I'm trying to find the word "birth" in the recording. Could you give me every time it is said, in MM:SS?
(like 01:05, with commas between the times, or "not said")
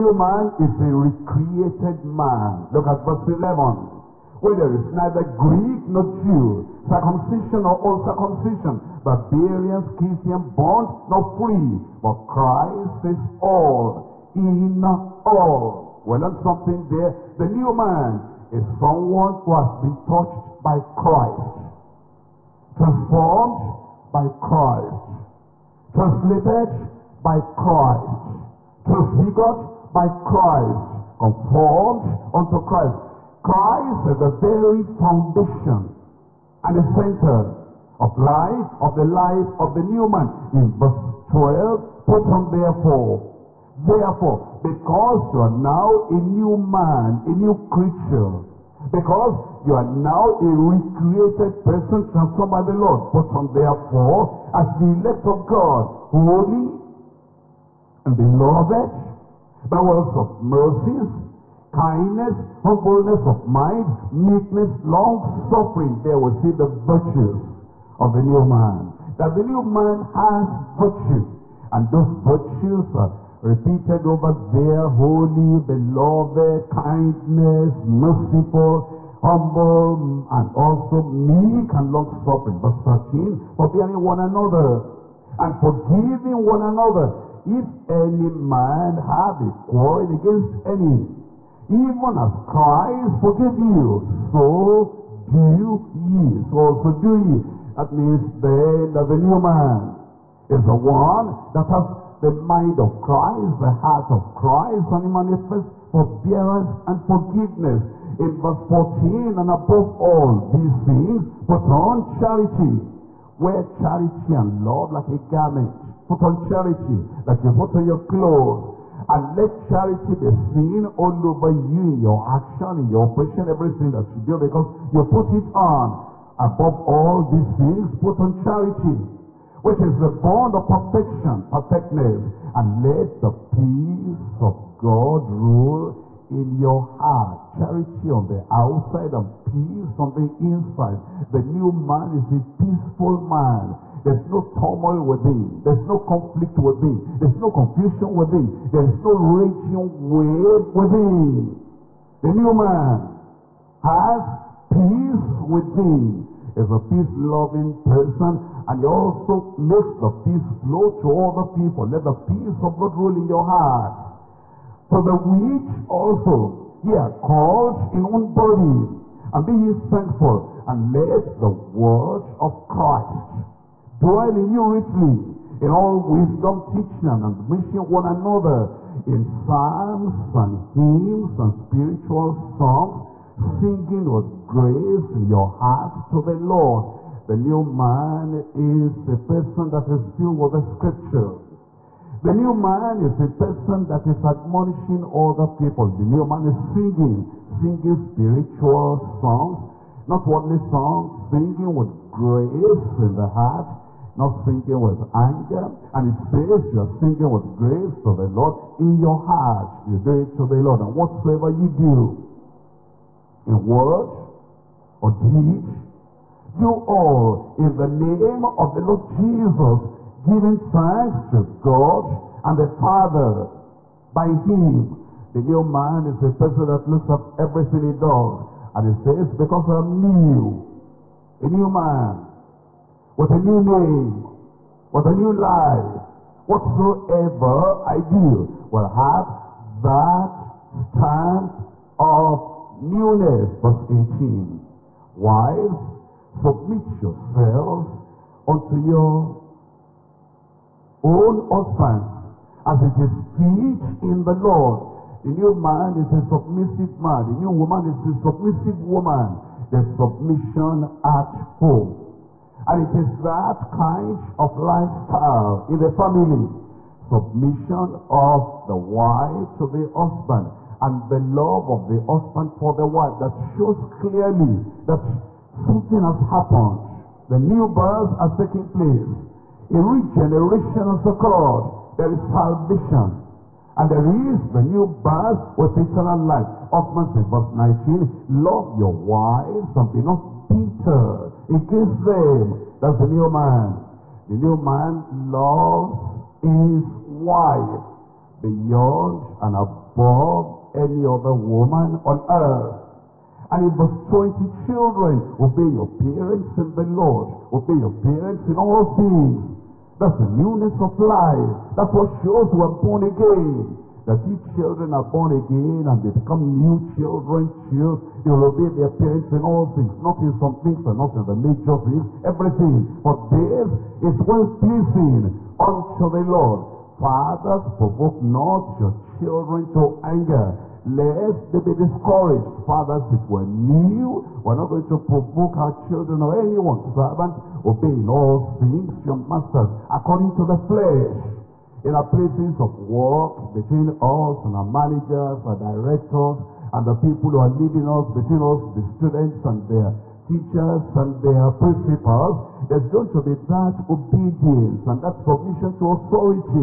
04:37, 04:45.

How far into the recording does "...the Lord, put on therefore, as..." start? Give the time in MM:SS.
00:52.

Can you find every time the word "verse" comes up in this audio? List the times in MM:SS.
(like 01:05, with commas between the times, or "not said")
00:03, 00:40, 01:22, 01:48, 04:03, 04:47, 05:03.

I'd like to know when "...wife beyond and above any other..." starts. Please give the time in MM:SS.
04:57.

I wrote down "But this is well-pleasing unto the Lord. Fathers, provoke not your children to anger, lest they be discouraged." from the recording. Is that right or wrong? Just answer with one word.
right.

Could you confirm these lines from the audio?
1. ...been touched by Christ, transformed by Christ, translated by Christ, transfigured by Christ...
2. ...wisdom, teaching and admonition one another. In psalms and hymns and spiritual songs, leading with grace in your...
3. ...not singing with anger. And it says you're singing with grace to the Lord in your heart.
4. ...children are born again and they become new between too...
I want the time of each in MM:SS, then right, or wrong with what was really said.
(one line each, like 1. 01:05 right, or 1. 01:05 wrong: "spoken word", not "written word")
1. 00:19 right
2. 02:56 wrong: "singing", not "leading"
3. 03:24 right
4. 05:14 wrong: "children", not "between".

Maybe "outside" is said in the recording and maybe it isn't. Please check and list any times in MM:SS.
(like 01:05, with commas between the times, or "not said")
02:18.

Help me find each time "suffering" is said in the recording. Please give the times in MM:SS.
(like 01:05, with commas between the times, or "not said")
01:04, 01:21.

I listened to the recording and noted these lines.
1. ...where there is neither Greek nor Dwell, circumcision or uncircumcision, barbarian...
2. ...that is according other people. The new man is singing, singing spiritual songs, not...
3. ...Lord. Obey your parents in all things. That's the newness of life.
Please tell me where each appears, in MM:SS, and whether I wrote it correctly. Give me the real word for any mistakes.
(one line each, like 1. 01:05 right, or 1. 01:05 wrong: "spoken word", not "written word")
1. 00:04 wrong: "Jew", not "Dwell"
2. 03:13 wrong: "admonishing", not "according"
3. 05:06 right.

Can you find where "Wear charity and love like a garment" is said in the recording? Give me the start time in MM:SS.
01:53.